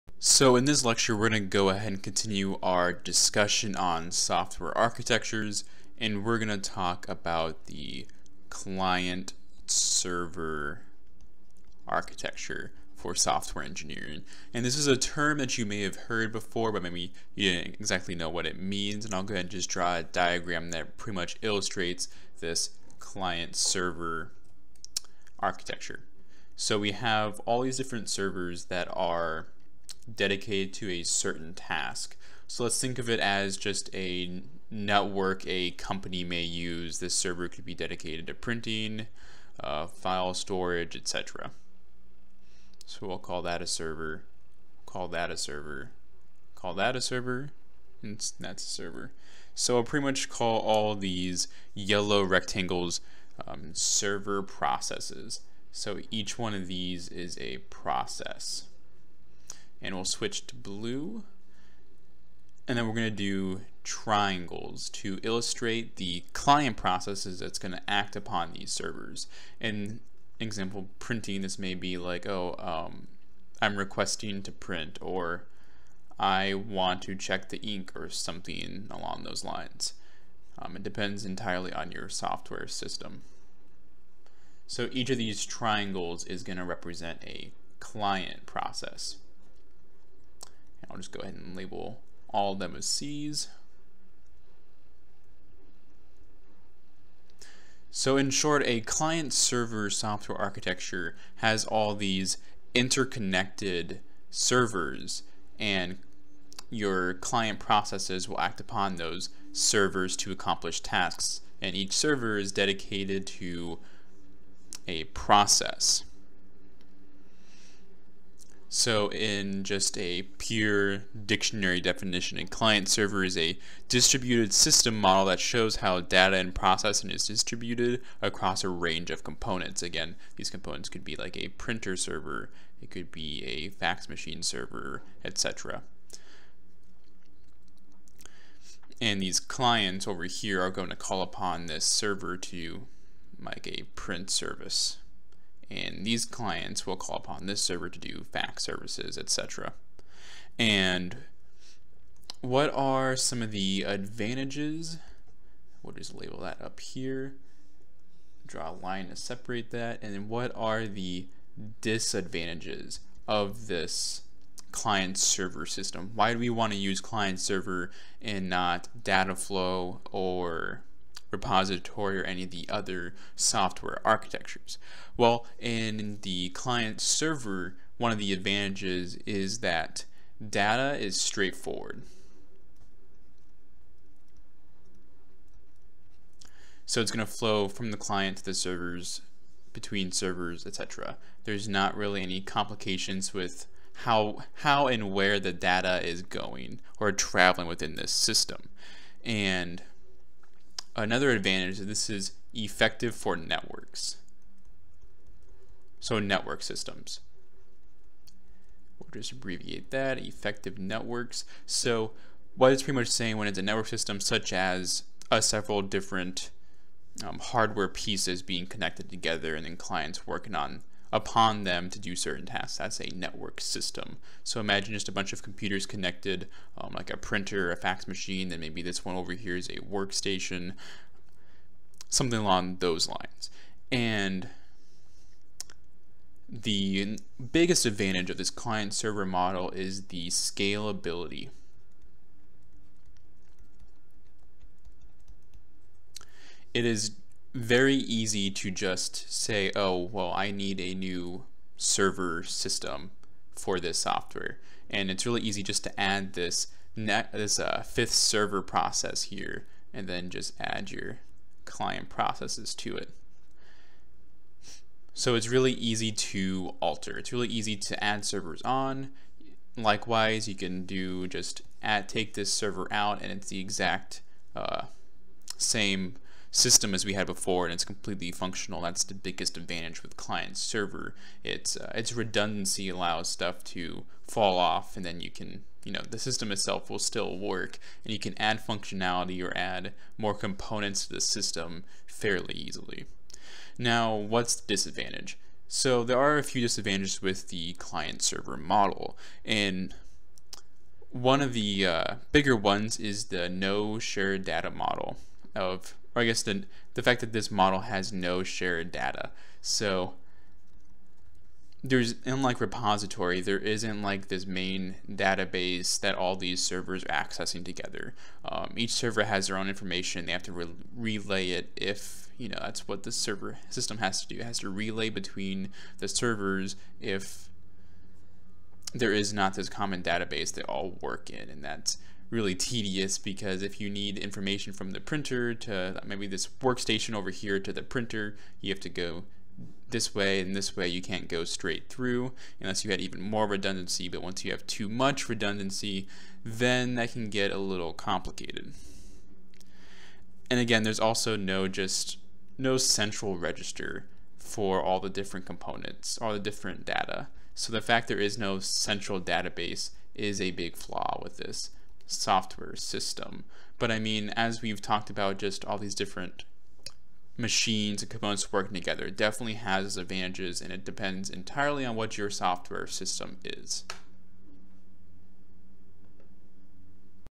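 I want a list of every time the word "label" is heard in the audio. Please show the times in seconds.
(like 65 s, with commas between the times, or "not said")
91 s, 156 s.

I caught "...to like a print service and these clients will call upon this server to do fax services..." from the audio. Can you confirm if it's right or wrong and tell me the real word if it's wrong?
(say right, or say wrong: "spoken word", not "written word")
right.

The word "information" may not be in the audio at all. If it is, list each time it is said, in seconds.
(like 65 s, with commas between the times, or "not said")
319 s, 334 s.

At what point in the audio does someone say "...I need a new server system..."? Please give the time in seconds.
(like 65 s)
250 s.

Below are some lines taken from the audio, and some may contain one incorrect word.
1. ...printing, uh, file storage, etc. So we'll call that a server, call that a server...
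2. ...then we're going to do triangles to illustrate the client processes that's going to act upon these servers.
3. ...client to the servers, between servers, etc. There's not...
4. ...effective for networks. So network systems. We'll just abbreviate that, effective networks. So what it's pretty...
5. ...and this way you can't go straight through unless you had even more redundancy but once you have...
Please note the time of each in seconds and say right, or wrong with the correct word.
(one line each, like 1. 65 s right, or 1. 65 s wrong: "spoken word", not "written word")
1. 38 s right
2. 62 s right
3. 187 s right
4. 202 s right
5. 340 s right.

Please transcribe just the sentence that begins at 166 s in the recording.
Why do we want to use client server and not data flow or repository or any of the other software architectures?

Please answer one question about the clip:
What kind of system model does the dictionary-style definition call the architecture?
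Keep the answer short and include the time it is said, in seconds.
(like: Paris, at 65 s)
Distributed system model, at 123 s.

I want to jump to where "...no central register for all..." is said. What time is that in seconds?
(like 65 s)
352 s.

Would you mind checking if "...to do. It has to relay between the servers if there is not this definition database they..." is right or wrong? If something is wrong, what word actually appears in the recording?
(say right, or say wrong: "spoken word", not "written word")
wrong: "common", not "definition".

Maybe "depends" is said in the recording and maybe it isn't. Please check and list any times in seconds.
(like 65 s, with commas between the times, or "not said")
80 s, 370 s.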